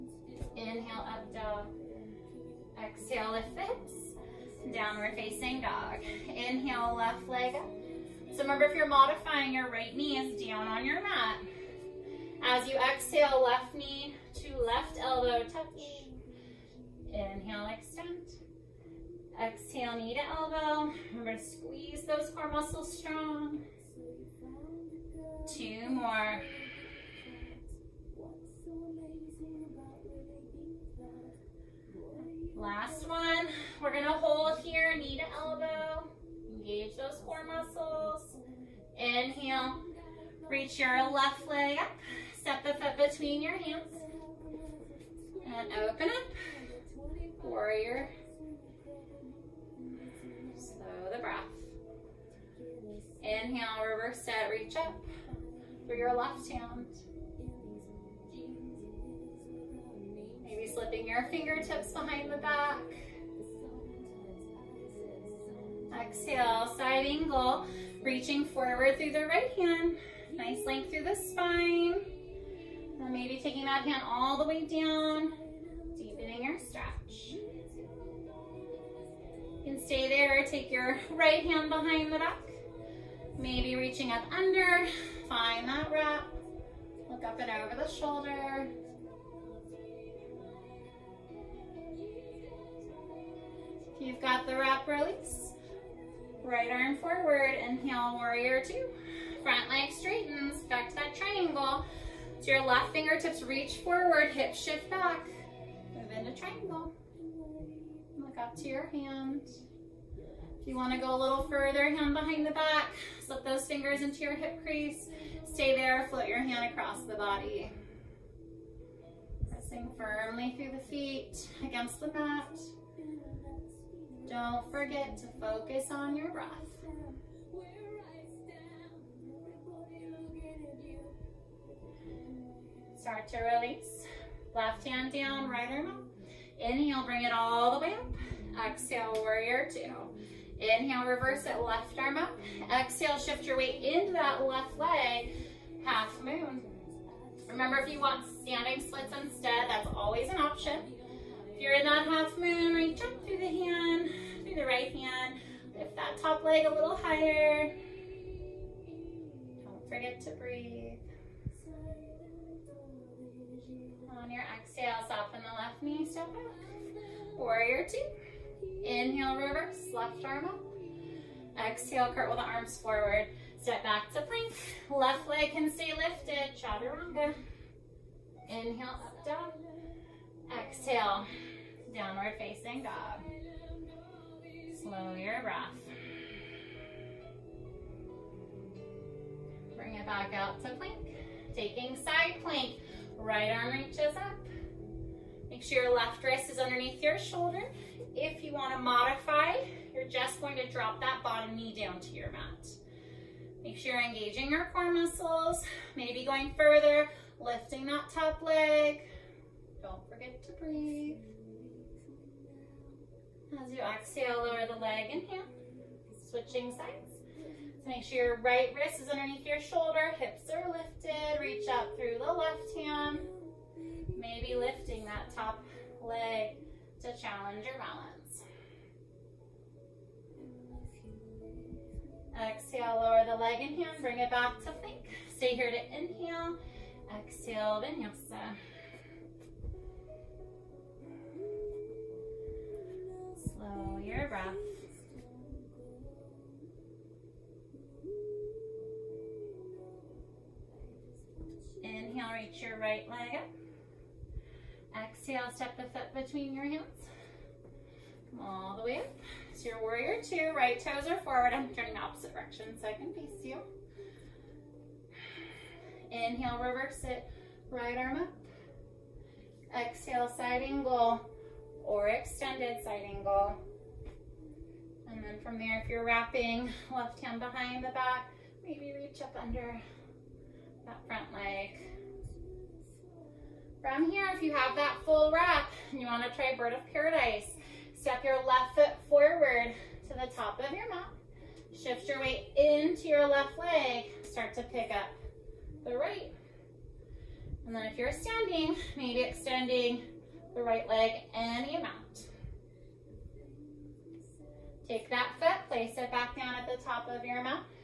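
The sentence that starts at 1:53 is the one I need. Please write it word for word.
Slip those fingers into your hip crease.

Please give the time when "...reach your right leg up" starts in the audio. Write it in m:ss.
4:12.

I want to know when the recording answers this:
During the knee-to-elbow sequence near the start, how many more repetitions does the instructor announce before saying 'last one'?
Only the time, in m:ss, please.
0:25.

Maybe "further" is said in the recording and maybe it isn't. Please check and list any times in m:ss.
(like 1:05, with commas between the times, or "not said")
1:51, 3:26.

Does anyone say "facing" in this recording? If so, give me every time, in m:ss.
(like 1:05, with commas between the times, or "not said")
0:05, 3:02.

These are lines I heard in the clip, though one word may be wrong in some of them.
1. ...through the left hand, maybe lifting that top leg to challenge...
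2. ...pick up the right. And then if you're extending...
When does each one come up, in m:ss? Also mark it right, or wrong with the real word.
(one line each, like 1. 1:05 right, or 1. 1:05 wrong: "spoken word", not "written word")
1. 3:41 right
2. 4:54 wrong: "standing", not "extending".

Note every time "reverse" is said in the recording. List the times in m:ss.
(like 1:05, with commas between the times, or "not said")
0:53, 2:21, 2:49, 4:26.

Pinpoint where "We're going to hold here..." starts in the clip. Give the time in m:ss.
0:33.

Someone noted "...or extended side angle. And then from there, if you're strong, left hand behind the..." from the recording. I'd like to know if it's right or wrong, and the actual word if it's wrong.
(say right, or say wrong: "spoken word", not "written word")
wrong: "wrapping", not "strong".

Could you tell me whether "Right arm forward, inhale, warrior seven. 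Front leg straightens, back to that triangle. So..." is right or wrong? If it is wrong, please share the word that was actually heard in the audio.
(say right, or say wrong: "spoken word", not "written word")
wrong: "two", not "seven".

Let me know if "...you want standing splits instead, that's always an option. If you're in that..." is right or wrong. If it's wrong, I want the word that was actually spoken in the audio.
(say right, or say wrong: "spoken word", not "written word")
right.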